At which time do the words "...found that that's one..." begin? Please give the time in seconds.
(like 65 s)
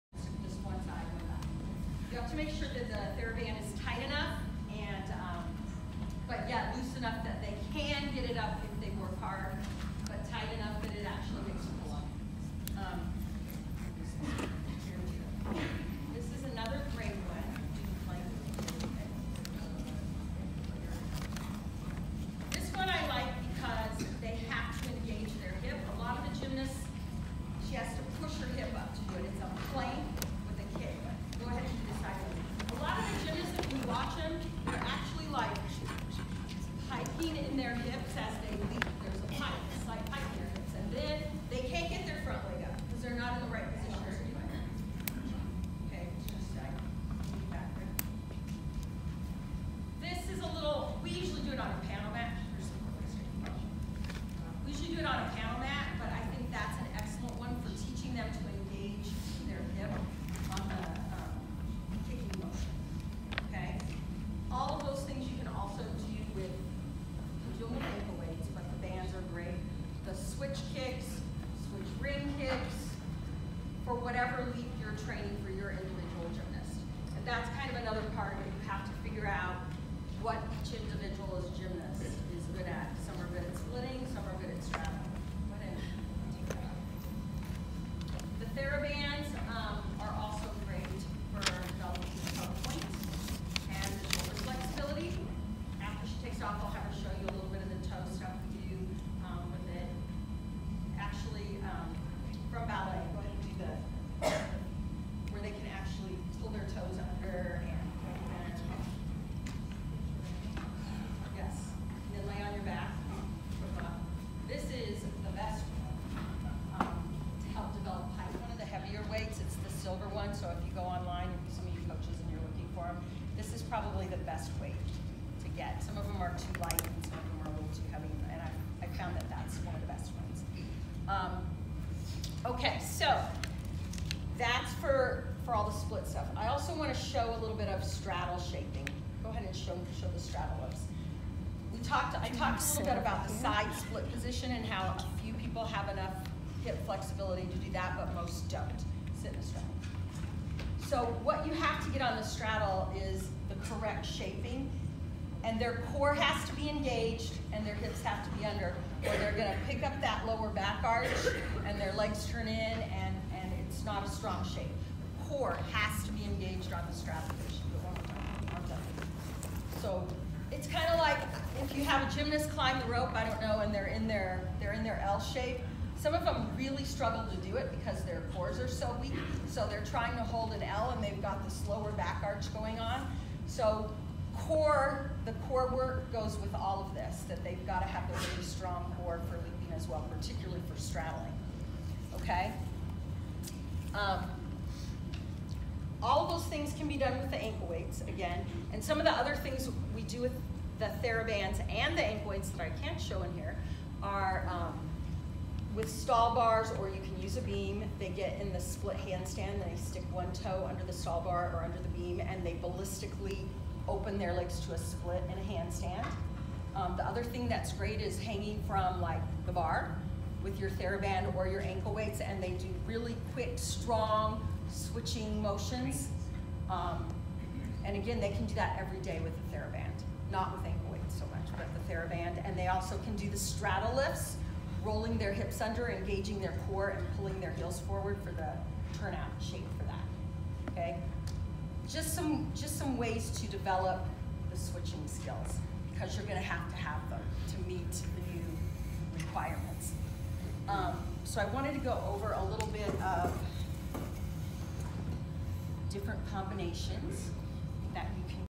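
128 s.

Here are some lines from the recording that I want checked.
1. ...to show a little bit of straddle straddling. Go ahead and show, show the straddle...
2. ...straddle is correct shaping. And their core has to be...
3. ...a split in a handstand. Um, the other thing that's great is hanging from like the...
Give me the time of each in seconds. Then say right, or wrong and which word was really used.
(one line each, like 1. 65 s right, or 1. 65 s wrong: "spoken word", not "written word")
1. 136 s wrong: "shaping", not "straddling"
2. 152 s right
3. 214 s right.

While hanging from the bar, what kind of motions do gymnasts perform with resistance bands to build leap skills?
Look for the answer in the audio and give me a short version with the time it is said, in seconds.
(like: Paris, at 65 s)
Quick, strong switching motions, at 222 s.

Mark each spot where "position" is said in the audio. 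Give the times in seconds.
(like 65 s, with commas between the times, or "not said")
144 s, 166 s.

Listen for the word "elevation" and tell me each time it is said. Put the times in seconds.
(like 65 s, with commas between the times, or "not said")
not said.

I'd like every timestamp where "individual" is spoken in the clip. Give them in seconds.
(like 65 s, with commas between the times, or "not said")
75 s.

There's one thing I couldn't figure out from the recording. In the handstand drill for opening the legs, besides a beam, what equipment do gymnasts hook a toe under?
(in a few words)
Stall bar.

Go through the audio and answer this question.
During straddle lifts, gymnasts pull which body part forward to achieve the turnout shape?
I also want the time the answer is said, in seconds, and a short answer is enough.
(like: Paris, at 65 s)
Heels, at 237 s.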